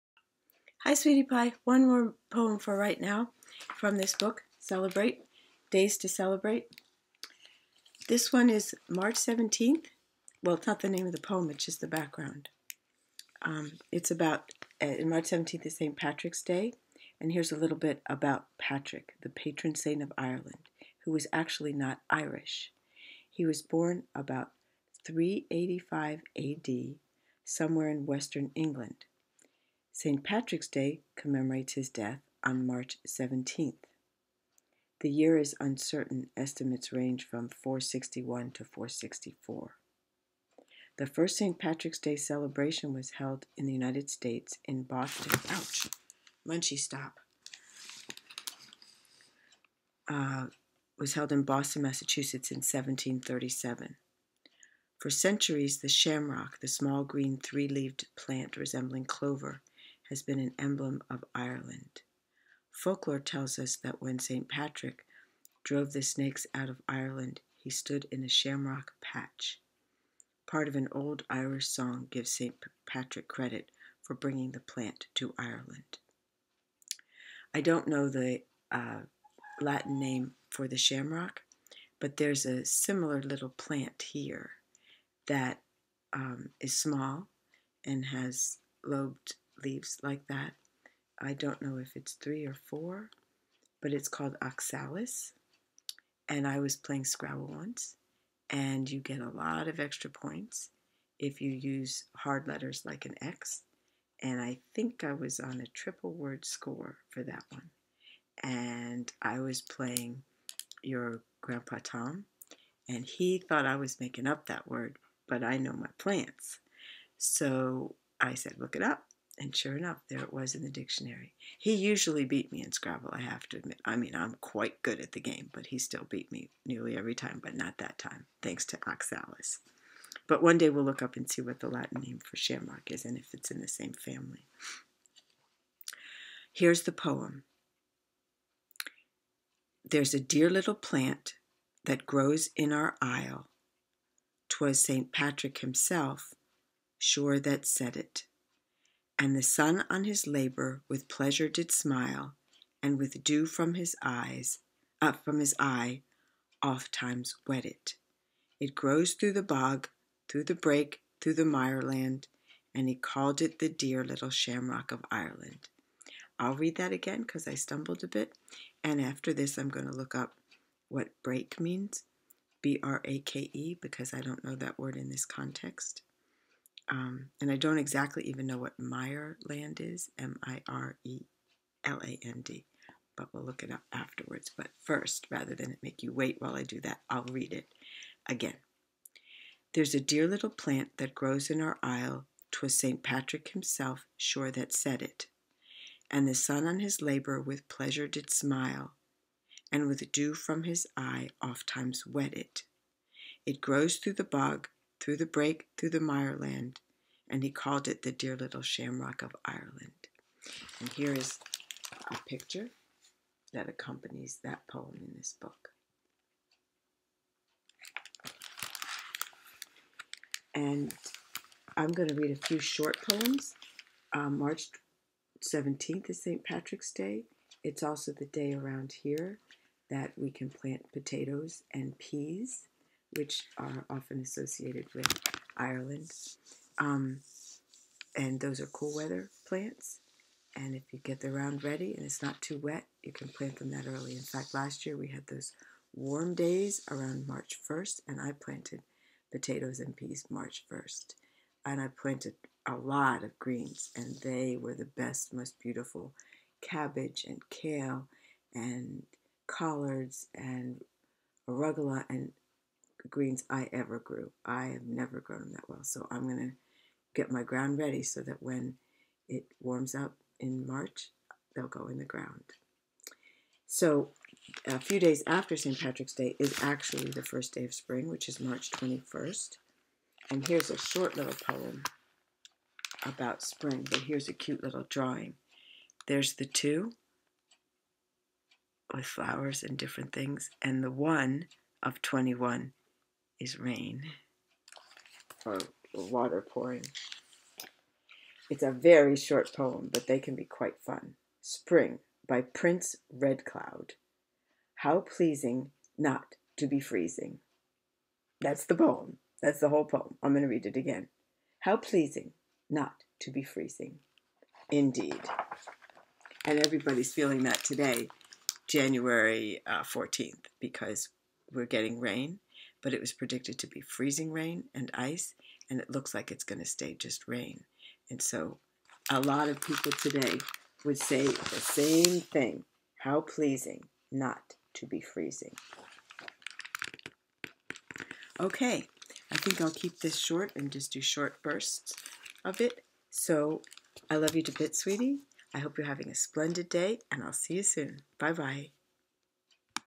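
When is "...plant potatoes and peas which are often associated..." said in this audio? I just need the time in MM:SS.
03:50.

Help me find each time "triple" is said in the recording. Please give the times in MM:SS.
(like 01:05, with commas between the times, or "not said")
01:45.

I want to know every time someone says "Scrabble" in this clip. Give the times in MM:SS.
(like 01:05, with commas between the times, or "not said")
01:37, 02:02.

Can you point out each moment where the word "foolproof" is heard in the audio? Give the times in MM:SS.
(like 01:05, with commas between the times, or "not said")
not said.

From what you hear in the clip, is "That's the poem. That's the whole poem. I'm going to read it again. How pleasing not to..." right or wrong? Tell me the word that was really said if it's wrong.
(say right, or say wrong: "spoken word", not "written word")
right.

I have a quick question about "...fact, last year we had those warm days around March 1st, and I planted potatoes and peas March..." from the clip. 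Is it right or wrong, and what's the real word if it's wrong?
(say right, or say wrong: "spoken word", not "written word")
right.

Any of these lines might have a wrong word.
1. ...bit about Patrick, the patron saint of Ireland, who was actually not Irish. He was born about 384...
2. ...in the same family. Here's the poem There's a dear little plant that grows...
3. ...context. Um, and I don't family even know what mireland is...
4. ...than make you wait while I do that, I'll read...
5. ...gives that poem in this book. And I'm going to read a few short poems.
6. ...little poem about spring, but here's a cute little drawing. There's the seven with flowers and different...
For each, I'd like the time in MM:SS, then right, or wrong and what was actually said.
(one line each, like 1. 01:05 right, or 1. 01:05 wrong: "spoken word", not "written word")
1. 00:17 wrong: "385", not "384"
2. 02:13 right
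3. 02:55 wrong: "exactly", not "family"
4. 03:05 right
5. 03:33 wrong: "accompanies", not "gives"
6. 04:41 wrong: "two", not "seven".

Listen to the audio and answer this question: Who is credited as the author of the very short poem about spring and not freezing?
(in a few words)
Prince Redcloud.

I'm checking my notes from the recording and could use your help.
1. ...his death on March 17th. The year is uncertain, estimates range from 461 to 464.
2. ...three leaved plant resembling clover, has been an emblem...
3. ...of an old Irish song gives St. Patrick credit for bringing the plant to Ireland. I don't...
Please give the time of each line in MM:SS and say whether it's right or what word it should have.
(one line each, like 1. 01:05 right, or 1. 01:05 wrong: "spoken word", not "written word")
1. 00:31 right
2. 00:57 right
3. 01:10 right.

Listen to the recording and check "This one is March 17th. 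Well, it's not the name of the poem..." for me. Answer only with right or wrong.
right.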